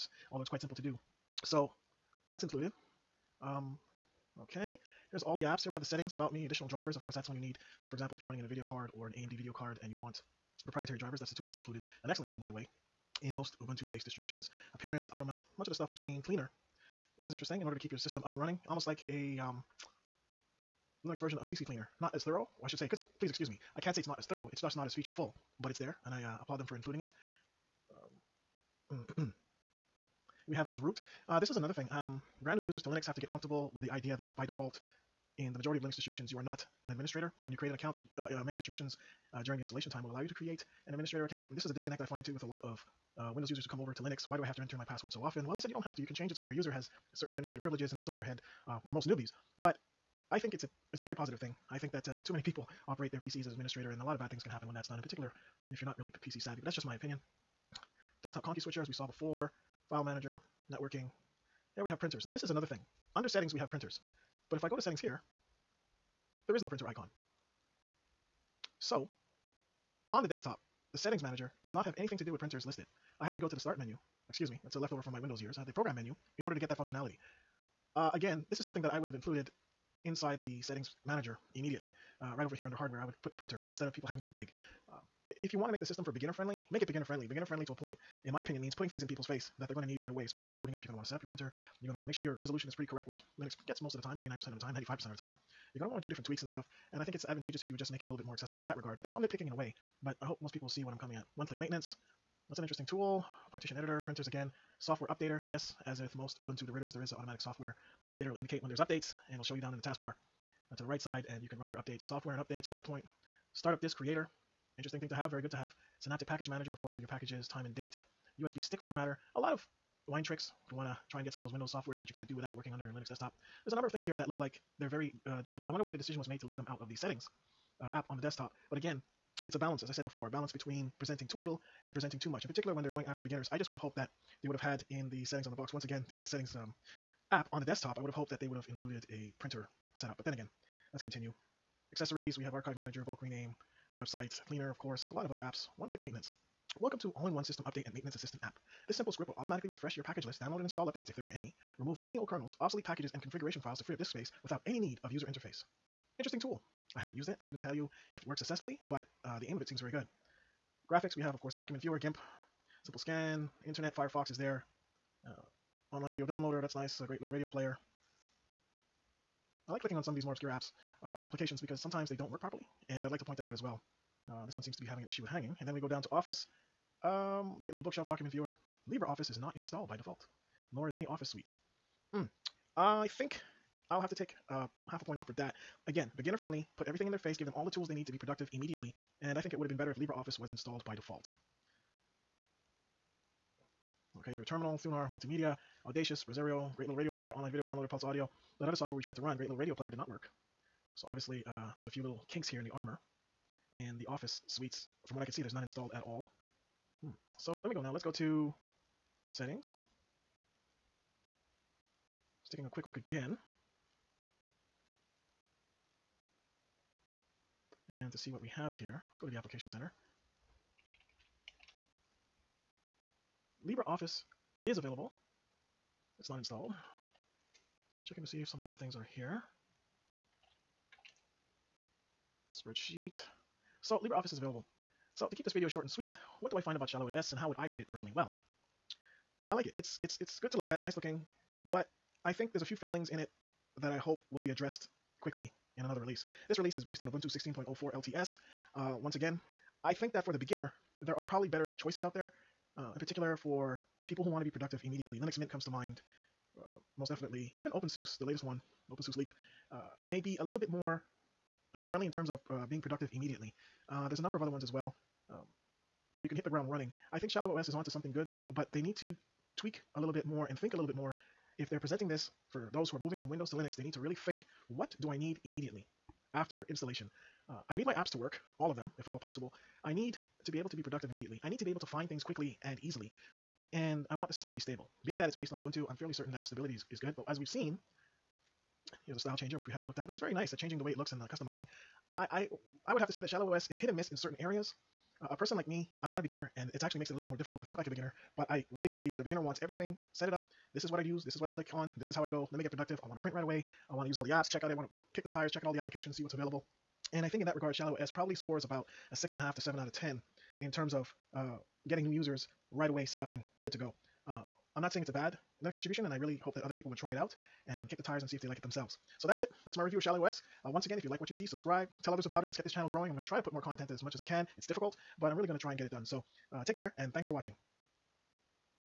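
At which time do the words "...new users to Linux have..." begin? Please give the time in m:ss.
0:32.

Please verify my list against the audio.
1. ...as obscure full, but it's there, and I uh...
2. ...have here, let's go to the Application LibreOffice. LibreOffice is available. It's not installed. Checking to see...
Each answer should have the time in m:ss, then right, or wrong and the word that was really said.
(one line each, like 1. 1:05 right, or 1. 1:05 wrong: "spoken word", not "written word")
1. 0:24 wrong: "feature", not "obscure"
2. 3:38 wrong: "Center", not "LibreOffice".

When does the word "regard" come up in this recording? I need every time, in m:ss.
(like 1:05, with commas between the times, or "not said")
1:38, 5:07.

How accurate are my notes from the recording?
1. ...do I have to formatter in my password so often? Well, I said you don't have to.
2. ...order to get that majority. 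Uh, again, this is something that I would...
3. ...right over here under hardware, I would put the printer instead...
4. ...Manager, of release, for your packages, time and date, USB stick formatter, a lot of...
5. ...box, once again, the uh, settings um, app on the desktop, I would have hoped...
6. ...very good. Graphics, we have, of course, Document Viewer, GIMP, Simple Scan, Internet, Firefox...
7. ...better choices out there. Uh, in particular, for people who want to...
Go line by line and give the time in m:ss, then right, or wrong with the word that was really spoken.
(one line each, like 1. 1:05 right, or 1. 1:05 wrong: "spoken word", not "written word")
1. 0:44 wrong: "enter", not "formatter"
2. 1:16 wrong: "functionality", not "majority"
3. 1:22 right
4. 1:56 wrong: "course", not "release"
5. 2:15 right
6. 2:39 right
7. 4:11 right.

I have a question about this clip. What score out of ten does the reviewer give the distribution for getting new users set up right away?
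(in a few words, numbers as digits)
6.5 to 7.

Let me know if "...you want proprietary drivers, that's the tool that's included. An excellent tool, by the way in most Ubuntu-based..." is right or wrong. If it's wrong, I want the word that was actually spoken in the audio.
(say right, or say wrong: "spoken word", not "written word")
right.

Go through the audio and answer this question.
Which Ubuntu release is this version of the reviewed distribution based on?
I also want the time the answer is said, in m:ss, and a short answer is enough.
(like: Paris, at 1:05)
Ubuntu 16.04 LTS, at 4:07.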